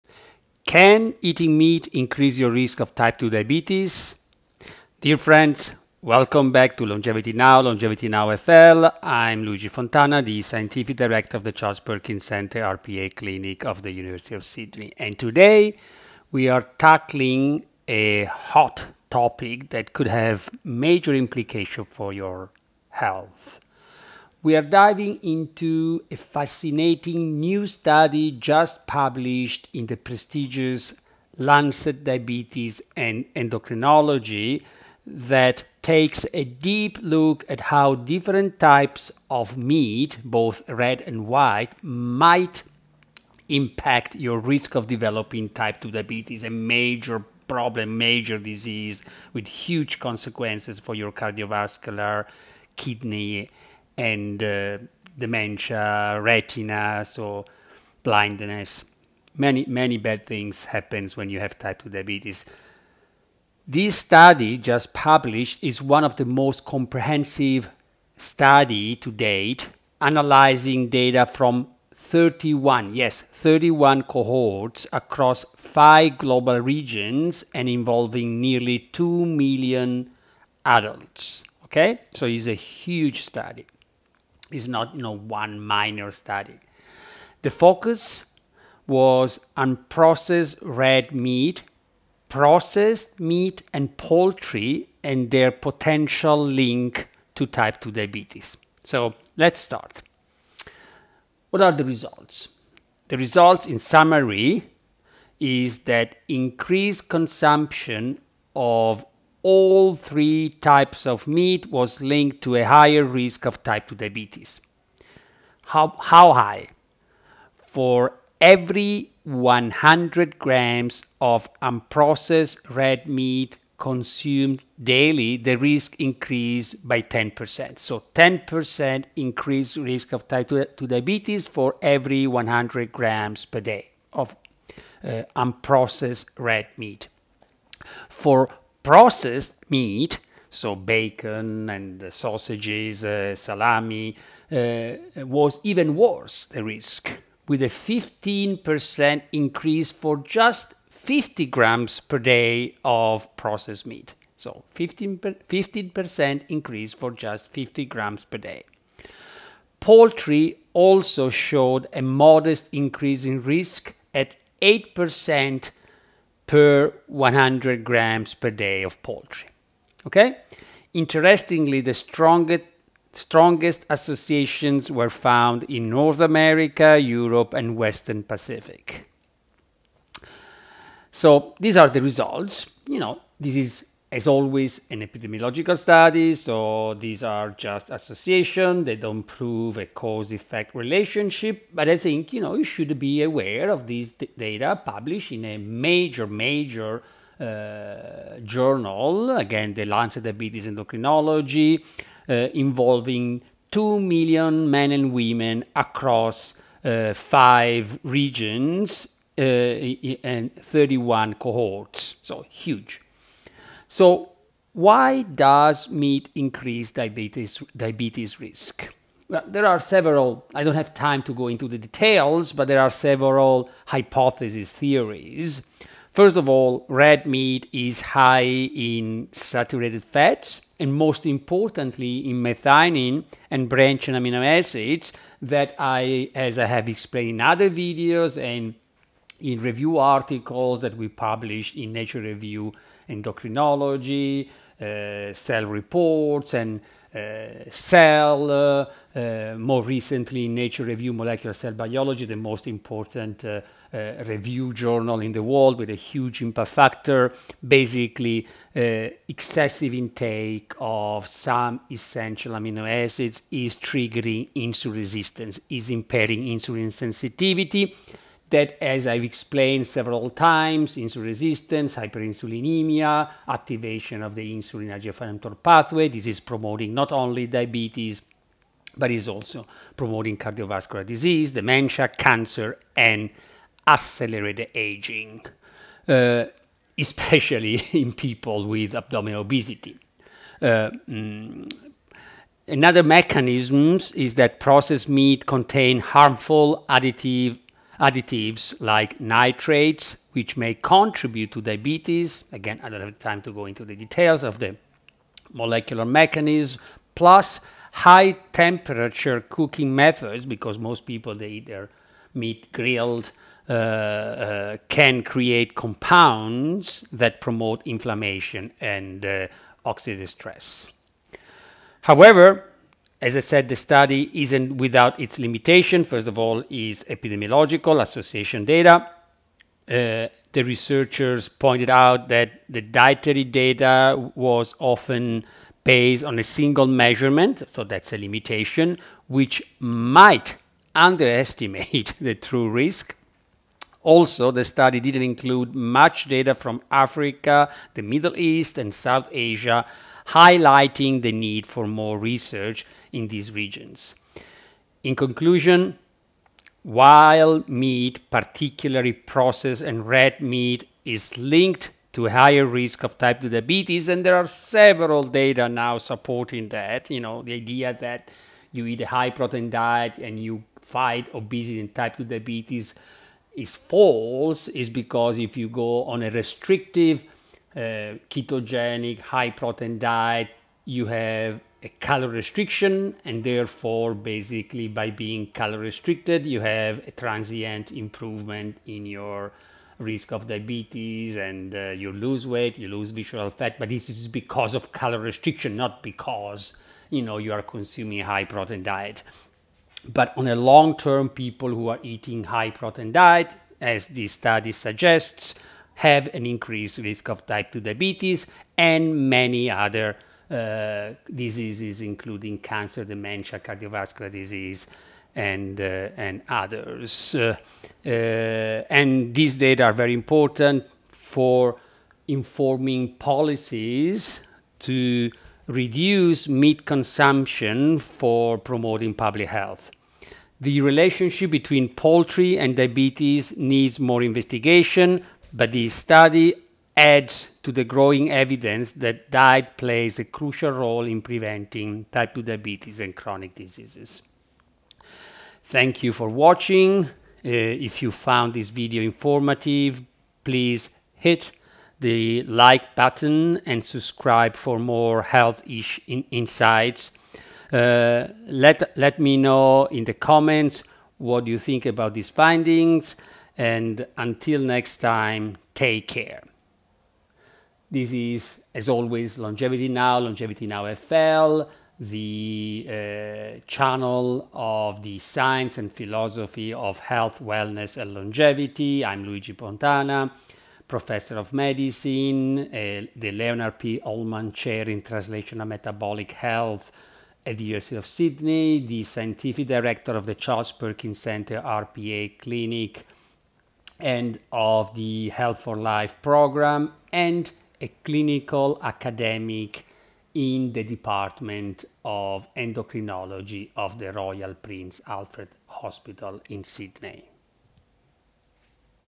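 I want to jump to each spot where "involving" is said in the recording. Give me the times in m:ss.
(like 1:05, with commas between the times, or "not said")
1:17, 3:22.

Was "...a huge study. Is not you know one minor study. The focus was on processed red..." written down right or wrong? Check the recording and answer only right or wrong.
right.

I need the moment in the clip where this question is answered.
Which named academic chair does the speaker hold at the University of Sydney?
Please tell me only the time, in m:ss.
8:03.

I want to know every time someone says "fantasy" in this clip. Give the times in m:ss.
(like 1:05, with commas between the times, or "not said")
not said.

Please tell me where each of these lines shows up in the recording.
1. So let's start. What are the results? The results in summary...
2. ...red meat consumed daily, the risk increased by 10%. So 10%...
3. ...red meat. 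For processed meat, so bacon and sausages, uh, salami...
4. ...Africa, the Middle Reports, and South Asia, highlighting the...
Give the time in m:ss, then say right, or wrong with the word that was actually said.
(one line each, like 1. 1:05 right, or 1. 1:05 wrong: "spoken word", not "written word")
1. 1:38 right
2. 2:02 right
3. 2:16 right
4. 5:46 wrong: "East", not "Reports".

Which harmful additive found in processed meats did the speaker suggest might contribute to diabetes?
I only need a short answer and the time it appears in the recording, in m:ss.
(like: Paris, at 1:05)
Nitrates, at 4:59.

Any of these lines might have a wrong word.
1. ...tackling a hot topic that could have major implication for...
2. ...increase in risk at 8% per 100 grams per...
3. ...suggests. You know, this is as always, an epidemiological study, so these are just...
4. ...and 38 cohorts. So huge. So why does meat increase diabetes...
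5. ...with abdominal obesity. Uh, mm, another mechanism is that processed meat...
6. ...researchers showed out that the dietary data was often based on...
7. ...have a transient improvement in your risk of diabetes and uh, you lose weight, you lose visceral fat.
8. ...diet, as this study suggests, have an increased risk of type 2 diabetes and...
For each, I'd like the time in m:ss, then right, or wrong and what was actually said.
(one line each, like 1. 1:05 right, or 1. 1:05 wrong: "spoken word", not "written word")
1. 0:16 right
2. 2:42 right
3. 3:02 wrong: "results", not "suggests"
4. 3:29 wrong: "31", not "38"
5. 4:48 right
6. 5:30 wrong: "pointed", not "showed"
7. 6:26 right
8. 6:43 right.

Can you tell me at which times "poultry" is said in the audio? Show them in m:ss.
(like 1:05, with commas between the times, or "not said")
1:33, 2:39, 2:49, 7:11.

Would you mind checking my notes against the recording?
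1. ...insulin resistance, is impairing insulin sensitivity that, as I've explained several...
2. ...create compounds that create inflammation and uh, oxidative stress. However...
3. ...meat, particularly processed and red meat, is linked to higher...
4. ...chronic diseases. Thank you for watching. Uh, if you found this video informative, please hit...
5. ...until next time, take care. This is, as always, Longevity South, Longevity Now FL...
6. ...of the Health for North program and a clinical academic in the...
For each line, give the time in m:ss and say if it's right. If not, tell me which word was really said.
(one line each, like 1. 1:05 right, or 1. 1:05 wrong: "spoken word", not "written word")
1. 4:24 right
2. 5:15 wrong: "promote", not "create"
3. 5:57 right
4. 7:23 right
5. 7:44 wrong: "Now", not "South"
6. 8:14 wrong: "Life", not "North".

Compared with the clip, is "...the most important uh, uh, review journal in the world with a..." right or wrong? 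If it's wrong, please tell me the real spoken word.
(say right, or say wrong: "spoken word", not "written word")
right.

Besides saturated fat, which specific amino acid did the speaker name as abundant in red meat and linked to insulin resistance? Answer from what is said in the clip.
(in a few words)
Methionine.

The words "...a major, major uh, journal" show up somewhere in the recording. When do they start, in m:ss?
3:15.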